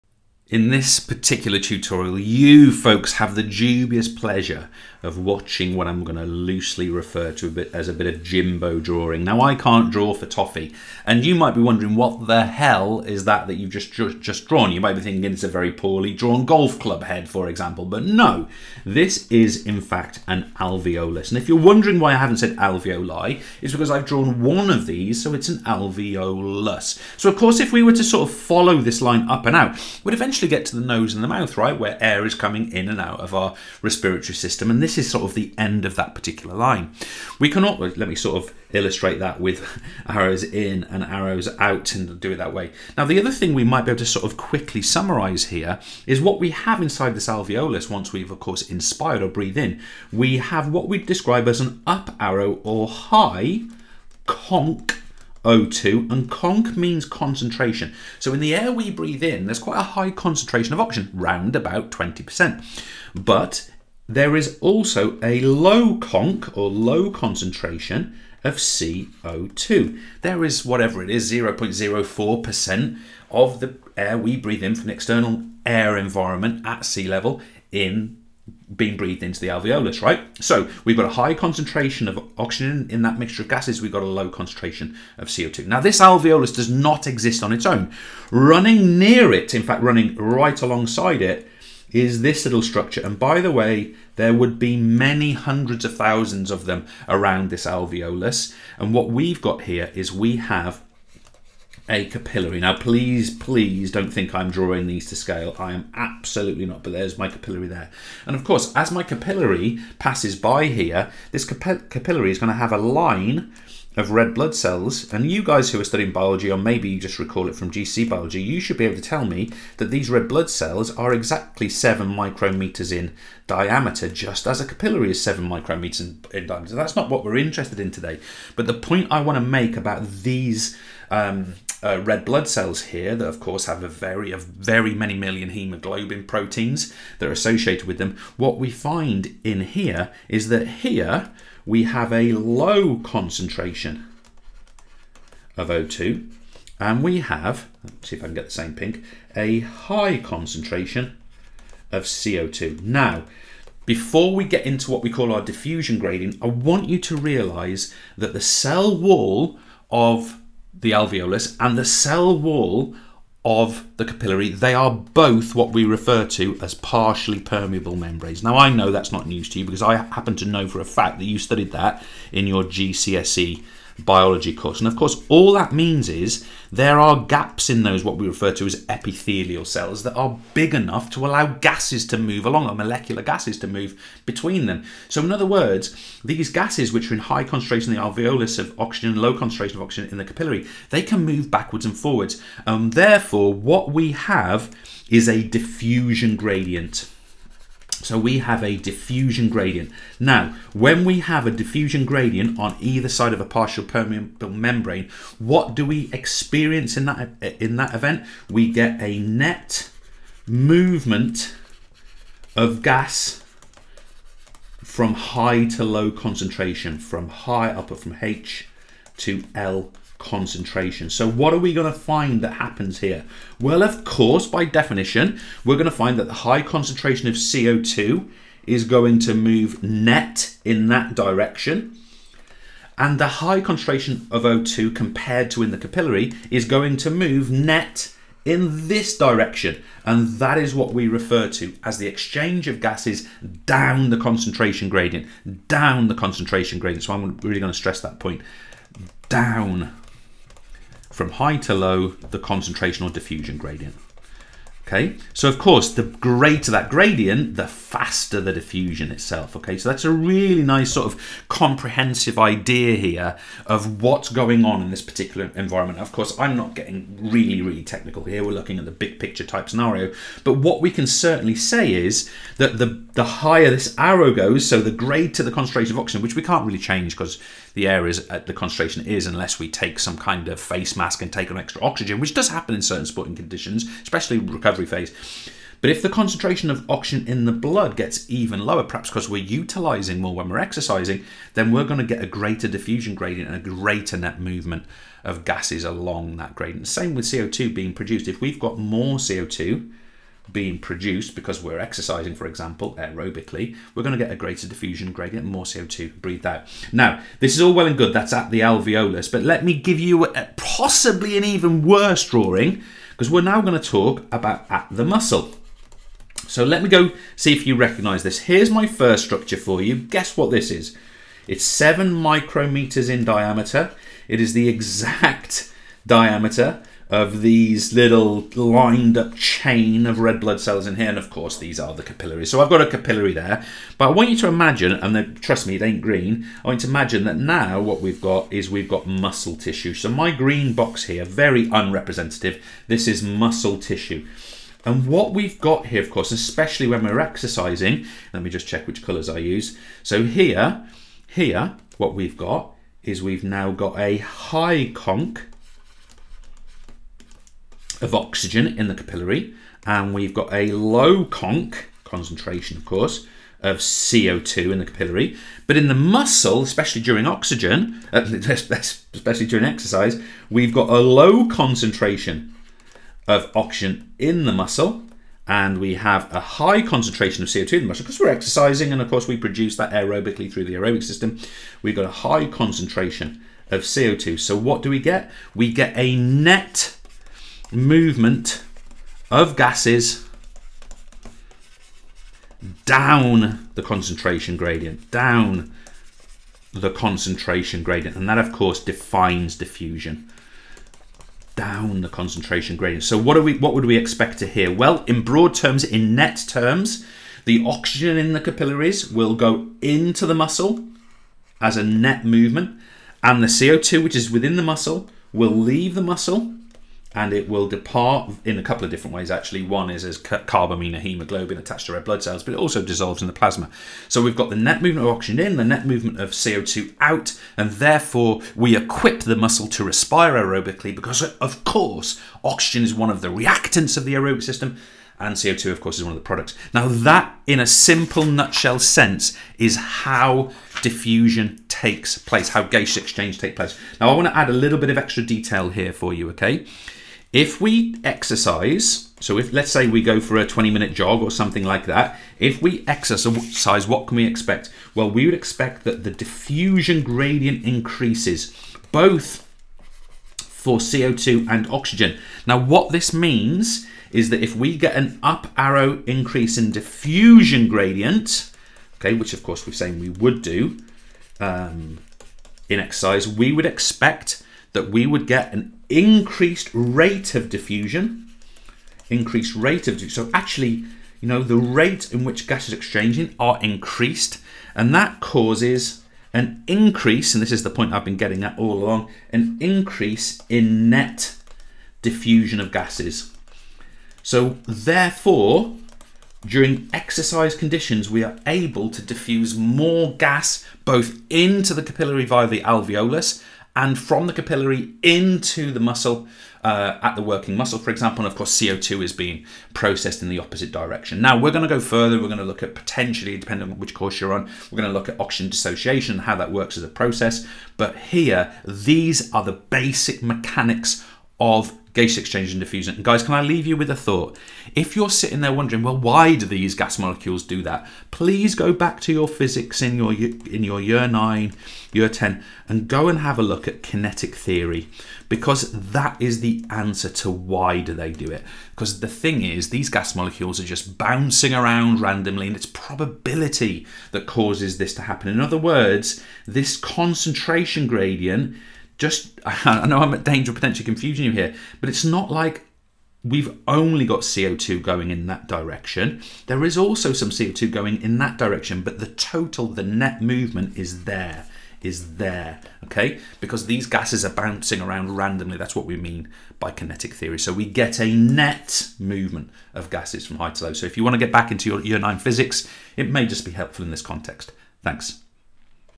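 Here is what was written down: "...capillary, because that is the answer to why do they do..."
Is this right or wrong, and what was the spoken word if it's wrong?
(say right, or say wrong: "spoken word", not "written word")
wrong: "theory", not "capillary".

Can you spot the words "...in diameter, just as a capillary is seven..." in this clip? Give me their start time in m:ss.
2:02.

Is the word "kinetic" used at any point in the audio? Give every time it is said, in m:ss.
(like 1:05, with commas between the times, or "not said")
8:53, 9:26.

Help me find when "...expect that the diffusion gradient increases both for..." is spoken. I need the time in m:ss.
7:35.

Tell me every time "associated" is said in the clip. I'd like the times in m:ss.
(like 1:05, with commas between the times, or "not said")
2:17.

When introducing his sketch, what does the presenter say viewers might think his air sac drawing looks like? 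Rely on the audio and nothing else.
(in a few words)
golf club head.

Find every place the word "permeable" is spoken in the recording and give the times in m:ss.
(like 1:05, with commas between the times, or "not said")
2:47, 3:23.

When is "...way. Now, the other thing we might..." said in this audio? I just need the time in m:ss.
0:42.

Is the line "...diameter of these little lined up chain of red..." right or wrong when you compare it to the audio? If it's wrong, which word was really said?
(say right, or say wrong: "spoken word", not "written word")
right.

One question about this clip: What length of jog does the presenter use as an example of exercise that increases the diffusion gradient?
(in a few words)
20 minutes.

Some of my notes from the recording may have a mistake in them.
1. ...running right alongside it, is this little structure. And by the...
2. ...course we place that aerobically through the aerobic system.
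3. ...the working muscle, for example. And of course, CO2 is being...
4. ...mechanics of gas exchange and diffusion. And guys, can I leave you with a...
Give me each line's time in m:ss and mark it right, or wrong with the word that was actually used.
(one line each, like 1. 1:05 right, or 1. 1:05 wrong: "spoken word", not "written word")
1. 1:29 right
2. 6:19 wrong: "produce", not "place"
3. 8:27 right
4. 8:40 right.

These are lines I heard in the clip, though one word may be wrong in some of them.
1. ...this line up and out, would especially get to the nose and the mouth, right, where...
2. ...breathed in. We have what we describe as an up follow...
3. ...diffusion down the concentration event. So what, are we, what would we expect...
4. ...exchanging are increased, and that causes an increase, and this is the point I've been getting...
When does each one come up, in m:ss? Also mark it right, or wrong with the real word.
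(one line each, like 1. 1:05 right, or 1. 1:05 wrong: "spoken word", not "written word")
1. 0:28 wrong: "eventually", not "especially"
2. 0:49 wrong: "arrow", not "follow"
3. 6:39 wrong: "gradient", not "event"
4. 8:02 right.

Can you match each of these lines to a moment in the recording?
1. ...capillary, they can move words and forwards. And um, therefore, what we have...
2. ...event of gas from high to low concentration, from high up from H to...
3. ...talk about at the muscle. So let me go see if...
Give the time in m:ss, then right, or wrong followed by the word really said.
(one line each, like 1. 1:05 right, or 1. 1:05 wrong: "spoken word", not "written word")
1. 3:10 wrong: "backwards", not "words"
2. 3:30 wrong: "movement", not "event"
3. 5:13 right.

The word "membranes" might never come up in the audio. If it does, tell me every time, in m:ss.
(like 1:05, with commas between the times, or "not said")
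2:47, 3:24.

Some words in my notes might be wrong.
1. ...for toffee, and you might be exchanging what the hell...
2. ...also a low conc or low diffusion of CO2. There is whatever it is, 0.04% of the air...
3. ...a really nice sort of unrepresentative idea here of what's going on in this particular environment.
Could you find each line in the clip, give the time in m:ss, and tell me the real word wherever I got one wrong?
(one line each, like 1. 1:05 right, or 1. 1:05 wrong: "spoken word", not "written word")
1. 0:10 wrong: "wondering", not "exchanging"
2. 1:04 wrong: "concentration", not "diffusion"
3. 4:20 wrong: "comprehensive", not "unrepresentative".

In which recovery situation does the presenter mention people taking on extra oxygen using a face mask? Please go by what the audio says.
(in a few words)
sporting conditions.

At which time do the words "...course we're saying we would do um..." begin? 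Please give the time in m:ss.
7:49.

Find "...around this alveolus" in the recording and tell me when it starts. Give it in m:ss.
1:37.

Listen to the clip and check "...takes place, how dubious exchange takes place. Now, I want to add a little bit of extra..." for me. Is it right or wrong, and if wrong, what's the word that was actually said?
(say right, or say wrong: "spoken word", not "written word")
wrong: "gaseous", not "dubious".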